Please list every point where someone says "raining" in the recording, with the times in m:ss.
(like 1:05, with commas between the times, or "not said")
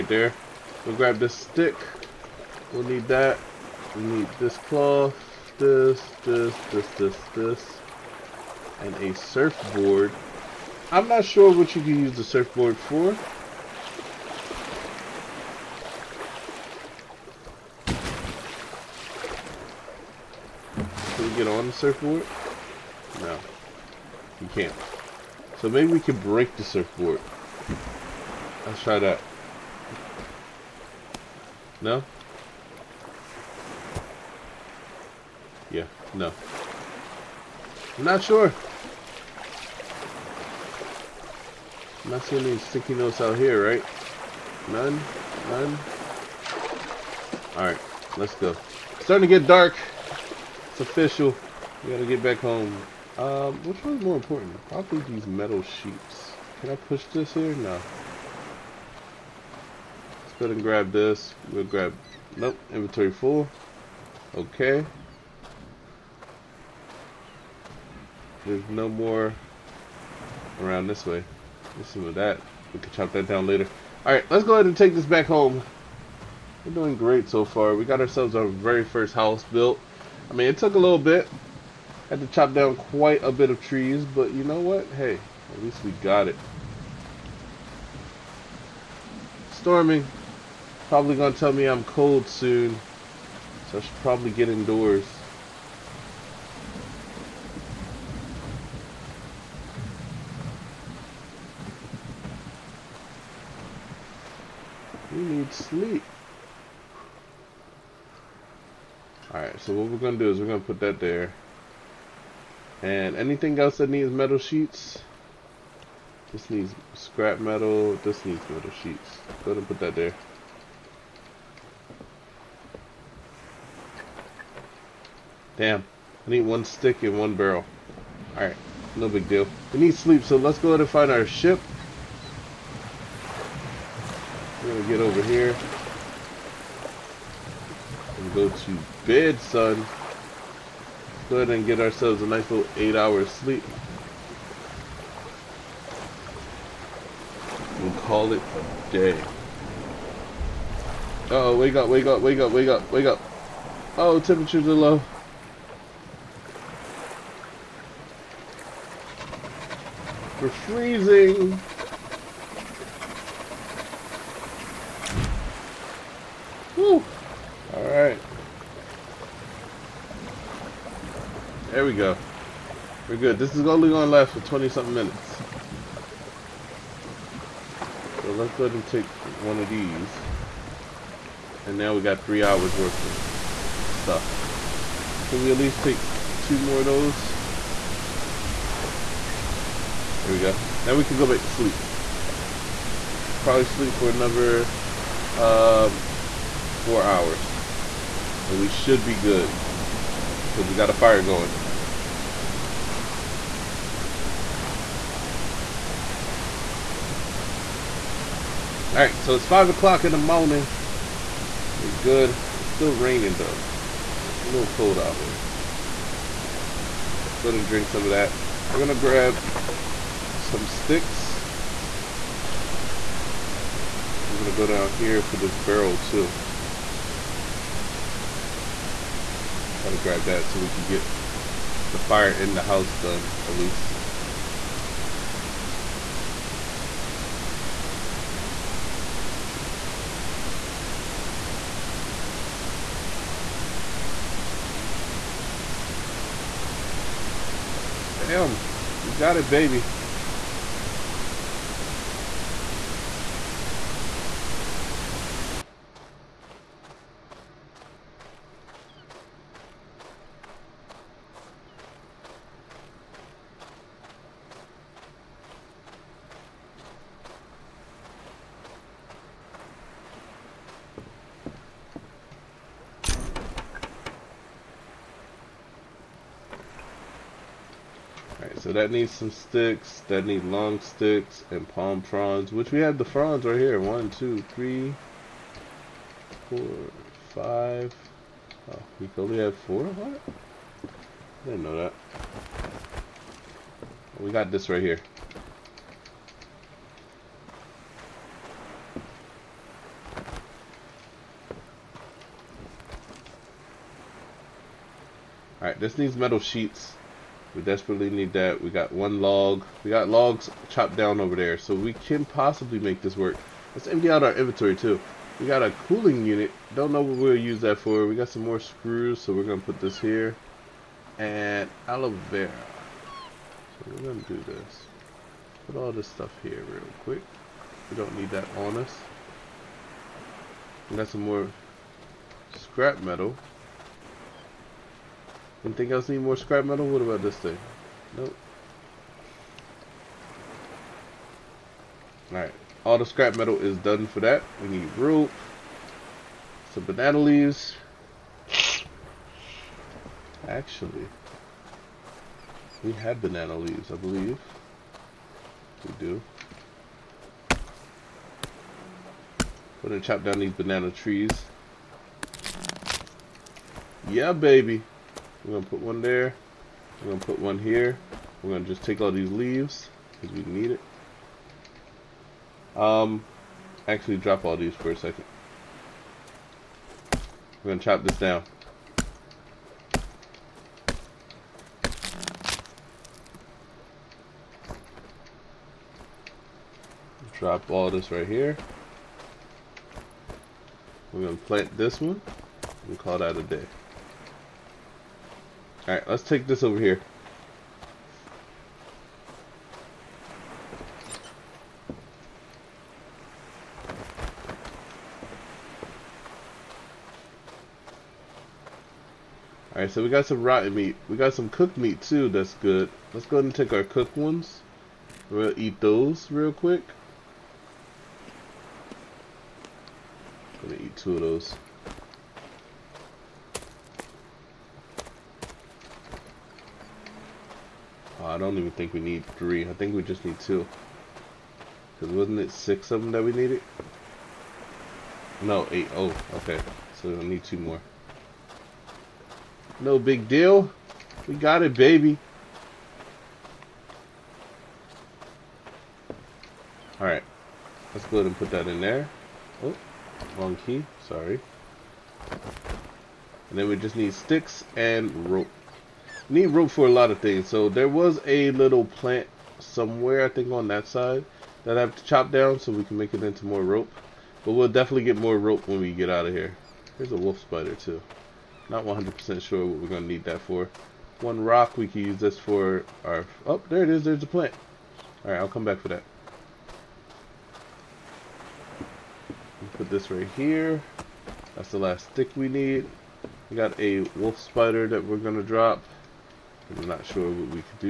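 3:32.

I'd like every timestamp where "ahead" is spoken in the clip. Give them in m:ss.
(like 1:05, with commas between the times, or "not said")
1:00, 1:14, 1:59, 2:10, 2:21, 6:53, 7:28.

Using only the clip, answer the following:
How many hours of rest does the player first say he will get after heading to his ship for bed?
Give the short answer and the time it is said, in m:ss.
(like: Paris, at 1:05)
8, at 2:22.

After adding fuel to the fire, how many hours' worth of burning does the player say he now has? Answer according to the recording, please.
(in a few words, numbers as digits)
3.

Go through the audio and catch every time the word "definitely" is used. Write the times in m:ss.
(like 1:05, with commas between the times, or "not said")
7:44.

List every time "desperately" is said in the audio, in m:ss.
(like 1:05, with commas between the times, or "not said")
5:07.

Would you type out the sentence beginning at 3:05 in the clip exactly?
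Can we at least take two more of those?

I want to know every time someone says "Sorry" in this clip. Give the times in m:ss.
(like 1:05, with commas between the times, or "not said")
7:31.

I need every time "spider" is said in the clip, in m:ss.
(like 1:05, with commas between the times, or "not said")
7:47, 8:04.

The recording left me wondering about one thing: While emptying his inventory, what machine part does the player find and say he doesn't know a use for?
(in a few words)
cooling unit.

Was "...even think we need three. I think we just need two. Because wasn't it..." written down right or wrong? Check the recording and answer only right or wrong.
right.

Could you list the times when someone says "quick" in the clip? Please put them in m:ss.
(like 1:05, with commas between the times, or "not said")
5:27, 6:56.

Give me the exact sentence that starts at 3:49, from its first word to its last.
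Try to grab that so we can get the fire in the house done at least.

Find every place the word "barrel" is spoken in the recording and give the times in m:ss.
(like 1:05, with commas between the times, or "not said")
2:07, 3:45.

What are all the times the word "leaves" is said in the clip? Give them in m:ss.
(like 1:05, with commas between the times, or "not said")
5:47, 5:53, 6:09.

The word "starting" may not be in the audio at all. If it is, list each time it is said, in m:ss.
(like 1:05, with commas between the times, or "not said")
0:49.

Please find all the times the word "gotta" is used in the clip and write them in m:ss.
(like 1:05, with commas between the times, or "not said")
0:51.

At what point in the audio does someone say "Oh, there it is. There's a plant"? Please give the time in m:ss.
7:53.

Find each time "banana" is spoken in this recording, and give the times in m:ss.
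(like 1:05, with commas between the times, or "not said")
5:46, 5:53, 6:00.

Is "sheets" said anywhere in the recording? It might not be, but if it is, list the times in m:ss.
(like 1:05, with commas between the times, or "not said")
0:55, 1:54, 1:58, 5:06.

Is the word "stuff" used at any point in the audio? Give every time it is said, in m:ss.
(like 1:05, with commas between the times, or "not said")
3:04, 5:26.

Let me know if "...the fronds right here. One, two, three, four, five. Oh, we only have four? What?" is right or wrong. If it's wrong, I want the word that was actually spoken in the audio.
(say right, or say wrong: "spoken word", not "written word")
right.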